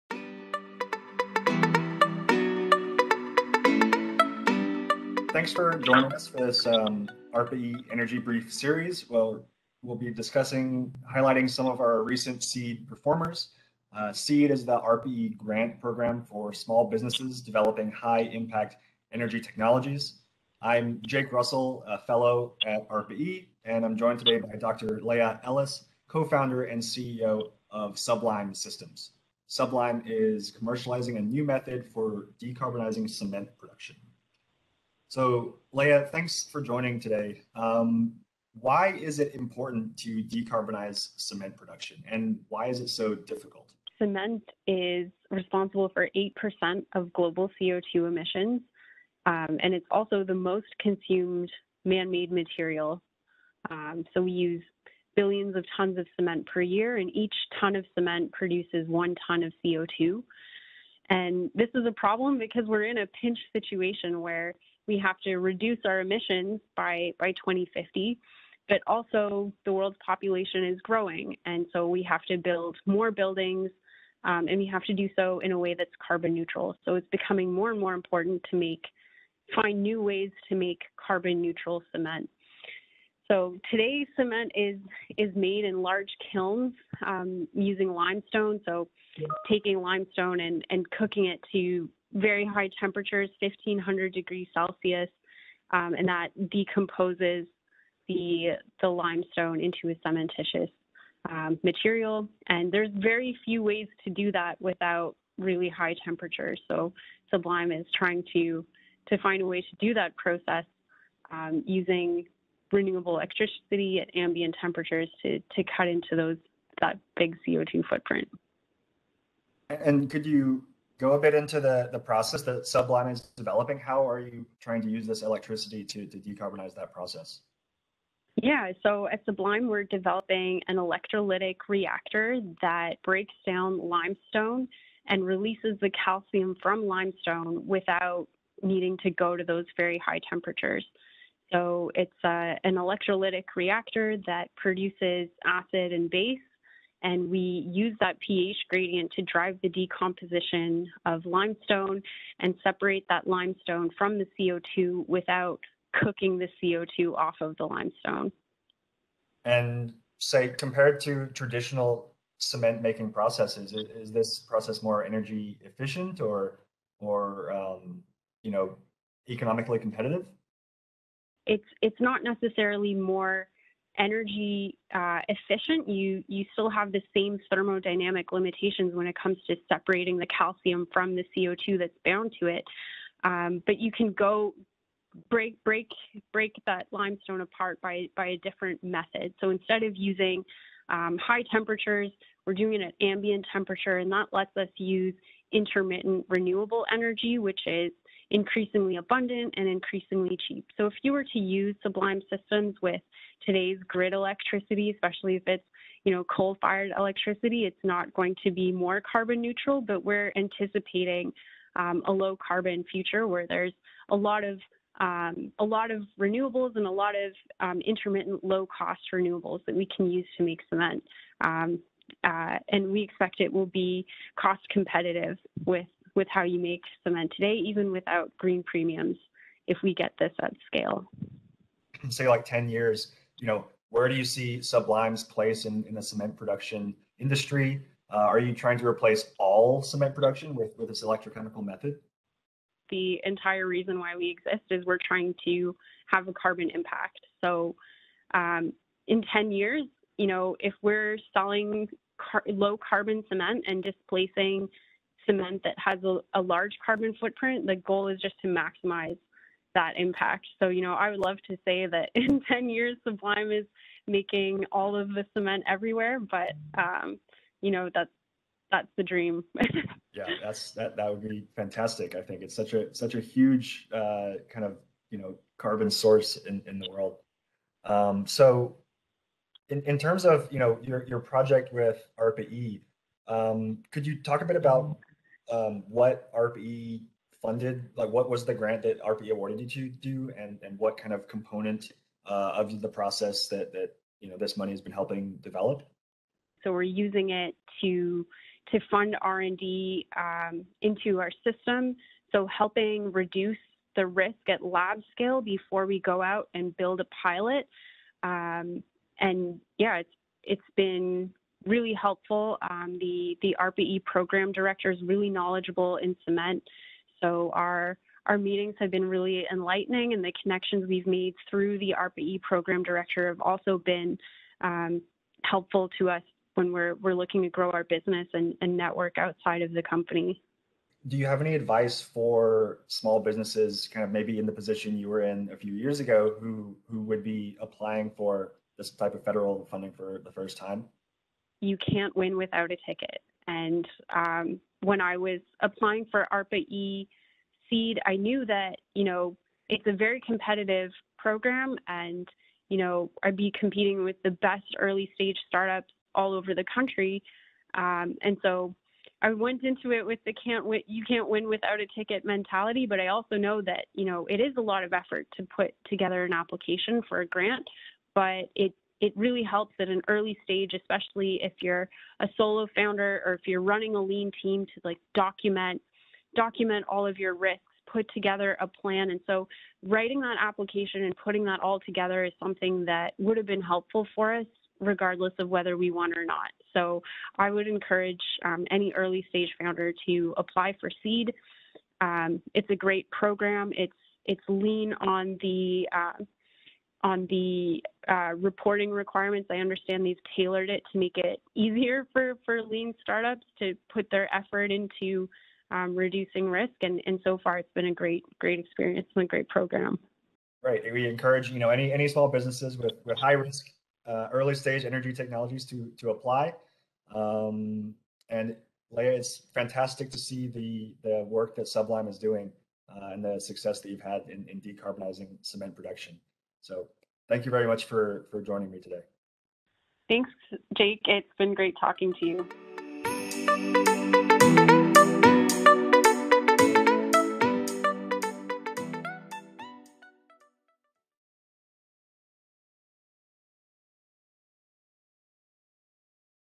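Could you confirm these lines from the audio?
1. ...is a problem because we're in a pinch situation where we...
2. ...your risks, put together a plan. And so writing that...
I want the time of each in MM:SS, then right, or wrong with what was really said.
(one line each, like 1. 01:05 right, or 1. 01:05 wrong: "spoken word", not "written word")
1. 01:01 right
2. 06:17 right.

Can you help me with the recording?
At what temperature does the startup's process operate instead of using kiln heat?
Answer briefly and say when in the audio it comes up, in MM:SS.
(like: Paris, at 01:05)
ambient temperature, at 03:13.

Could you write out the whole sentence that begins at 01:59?
And could you go a bit into the, the process that Sublime is developing.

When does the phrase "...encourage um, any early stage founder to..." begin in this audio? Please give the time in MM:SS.
06:27.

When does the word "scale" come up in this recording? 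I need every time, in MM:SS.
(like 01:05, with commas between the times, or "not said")
03:50, 05:05.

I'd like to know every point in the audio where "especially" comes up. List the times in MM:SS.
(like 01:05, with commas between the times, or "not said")
03:24, 06:10.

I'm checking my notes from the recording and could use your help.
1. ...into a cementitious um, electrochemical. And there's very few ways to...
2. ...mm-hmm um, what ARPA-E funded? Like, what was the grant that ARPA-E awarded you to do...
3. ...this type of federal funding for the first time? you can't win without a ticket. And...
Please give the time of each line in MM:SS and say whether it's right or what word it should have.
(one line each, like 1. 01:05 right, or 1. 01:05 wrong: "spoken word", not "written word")
1. 01:39 wrong: "material", not "electrochemical"
2. 04:44 right
3. 05:38 right.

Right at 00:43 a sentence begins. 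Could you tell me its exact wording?
Cement is responsible for 8% of global CO2 emissions, um, and it's also the most consumed man made material.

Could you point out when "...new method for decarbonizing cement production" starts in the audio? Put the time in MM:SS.
00:31.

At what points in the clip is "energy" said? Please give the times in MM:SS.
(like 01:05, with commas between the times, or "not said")
00:07, 00:19, 02:45, 02:53, 03:16, 06:54.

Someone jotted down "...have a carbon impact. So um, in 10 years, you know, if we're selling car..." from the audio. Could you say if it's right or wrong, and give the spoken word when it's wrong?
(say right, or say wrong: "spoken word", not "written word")
right.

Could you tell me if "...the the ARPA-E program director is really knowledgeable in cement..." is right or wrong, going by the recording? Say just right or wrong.
right.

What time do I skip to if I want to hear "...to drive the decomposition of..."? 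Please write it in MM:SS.
02:29.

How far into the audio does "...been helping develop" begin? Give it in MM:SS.
04:54.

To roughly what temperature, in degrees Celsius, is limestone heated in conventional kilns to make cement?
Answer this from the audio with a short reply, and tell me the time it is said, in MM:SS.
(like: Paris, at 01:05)
1500, at 01:33.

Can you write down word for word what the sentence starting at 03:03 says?
Um, but you can go break break break that limestone apart by by a different method.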